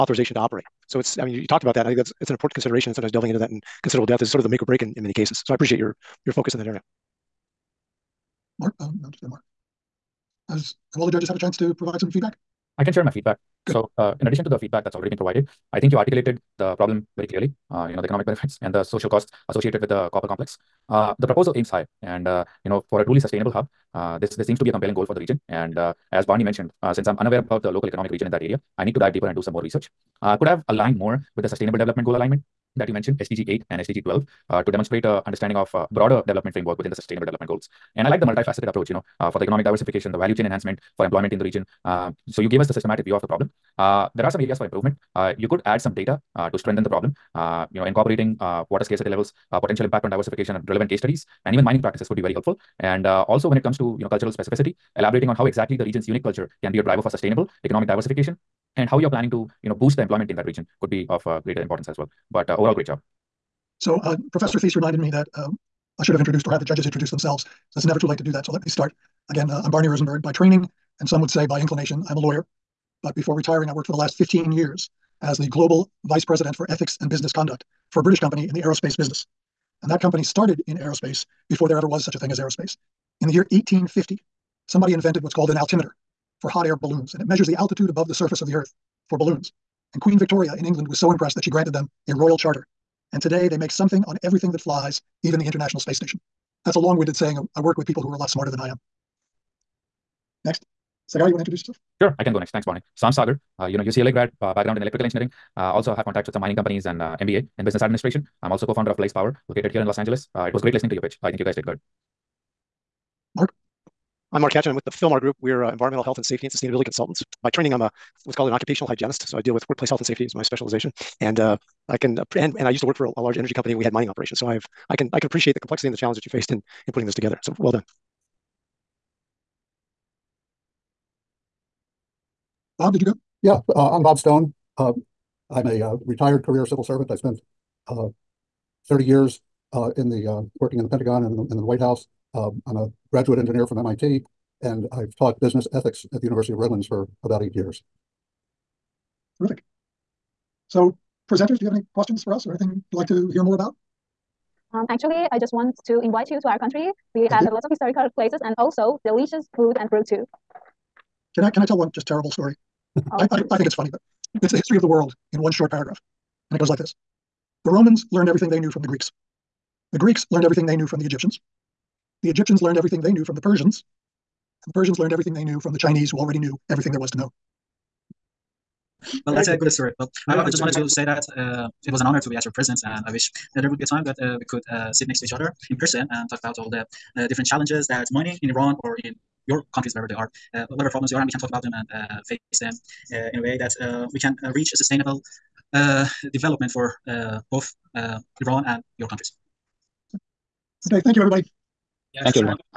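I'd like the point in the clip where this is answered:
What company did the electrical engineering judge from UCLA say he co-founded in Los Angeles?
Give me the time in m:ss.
1:48.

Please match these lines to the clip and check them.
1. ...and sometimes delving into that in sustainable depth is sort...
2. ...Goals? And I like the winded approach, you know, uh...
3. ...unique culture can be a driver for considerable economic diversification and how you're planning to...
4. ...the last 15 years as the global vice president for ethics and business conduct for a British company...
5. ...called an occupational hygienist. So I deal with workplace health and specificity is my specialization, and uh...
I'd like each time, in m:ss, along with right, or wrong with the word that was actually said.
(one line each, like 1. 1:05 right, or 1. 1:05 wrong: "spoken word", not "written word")
1. 0:02 wrong: "considerable", not "sustainable"
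2. 0:37 wrong: "multifaceted", not "winded"
3. 0:56 wrong: "sustainable", not "considerable"
4. 1:13 right
5. 1:58 wrong: "safety", not "specificity".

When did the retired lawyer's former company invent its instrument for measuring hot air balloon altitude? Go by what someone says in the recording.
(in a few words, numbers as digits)
1850.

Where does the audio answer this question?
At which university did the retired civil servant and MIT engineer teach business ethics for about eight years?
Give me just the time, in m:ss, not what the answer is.
2:26.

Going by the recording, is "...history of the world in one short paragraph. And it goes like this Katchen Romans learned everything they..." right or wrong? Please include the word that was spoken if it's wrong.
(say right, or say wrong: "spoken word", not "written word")
wrong: "The", not "Katchen".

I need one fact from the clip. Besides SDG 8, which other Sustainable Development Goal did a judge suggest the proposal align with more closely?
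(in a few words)
SDG 12.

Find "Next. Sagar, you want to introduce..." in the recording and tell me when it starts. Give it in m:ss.
1:40.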